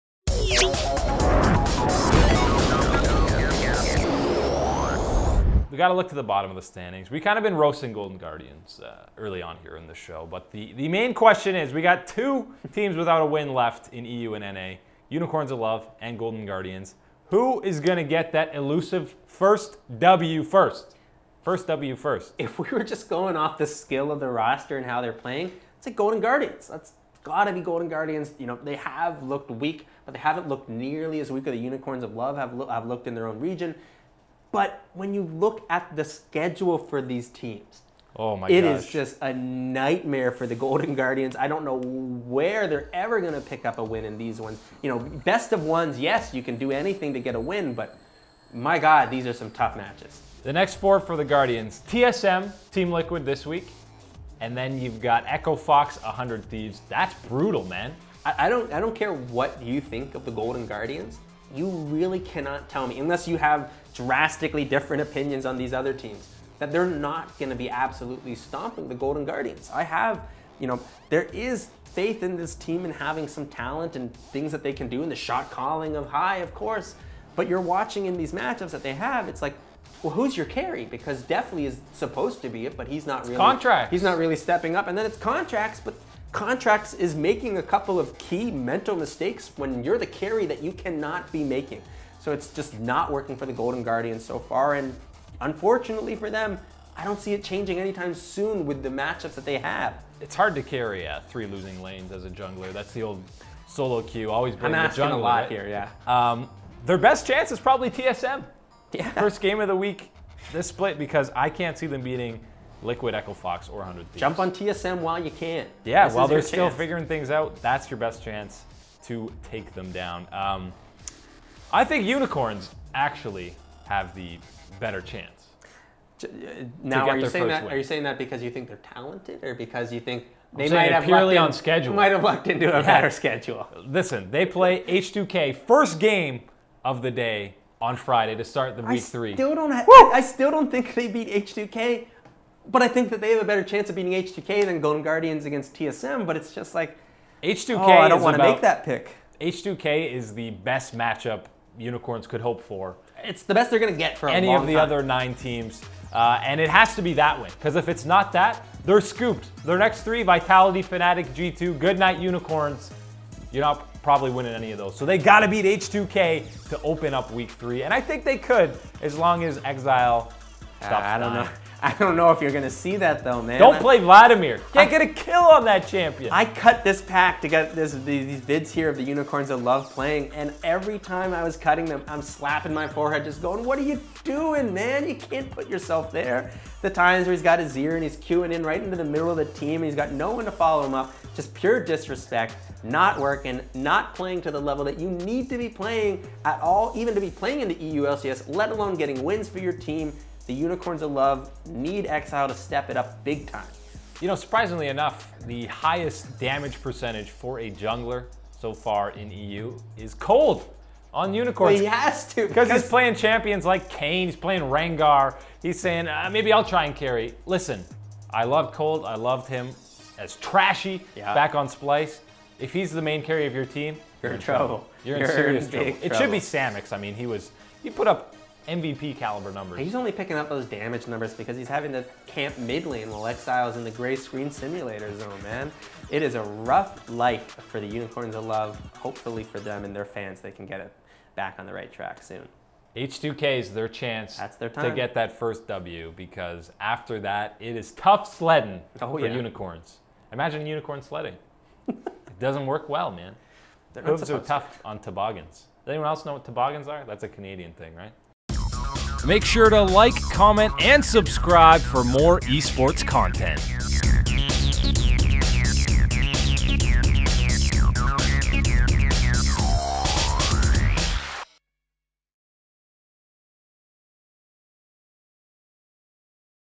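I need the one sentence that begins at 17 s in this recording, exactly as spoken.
Who is going to get that elusive first W first?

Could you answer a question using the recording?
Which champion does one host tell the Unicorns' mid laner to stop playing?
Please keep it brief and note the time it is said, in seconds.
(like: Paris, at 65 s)
Vladimir, at 173 s.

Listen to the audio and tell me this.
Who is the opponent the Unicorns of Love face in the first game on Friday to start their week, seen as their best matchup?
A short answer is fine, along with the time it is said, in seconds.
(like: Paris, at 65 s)
H2K, at 134 s.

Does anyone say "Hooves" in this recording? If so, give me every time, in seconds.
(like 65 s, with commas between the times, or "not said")
254 s.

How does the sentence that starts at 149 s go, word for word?
H2K is the best matchup Unicorns could hope for.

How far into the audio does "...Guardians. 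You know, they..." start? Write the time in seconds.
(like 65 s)
27 s.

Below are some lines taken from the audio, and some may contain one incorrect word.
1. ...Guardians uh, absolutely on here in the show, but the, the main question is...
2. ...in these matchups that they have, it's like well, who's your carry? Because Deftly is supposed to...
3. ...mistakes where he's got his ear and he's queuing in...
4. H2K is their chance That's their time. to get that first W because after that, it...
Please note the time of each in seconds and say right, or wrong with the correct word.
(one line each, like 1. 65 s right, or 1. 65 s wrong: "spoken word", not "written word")
1. 8 s wrong: "early", not "absolutely"
2. 78 s right
3. 186 s wrong: "times", not "mistakes"
4. 242 s right.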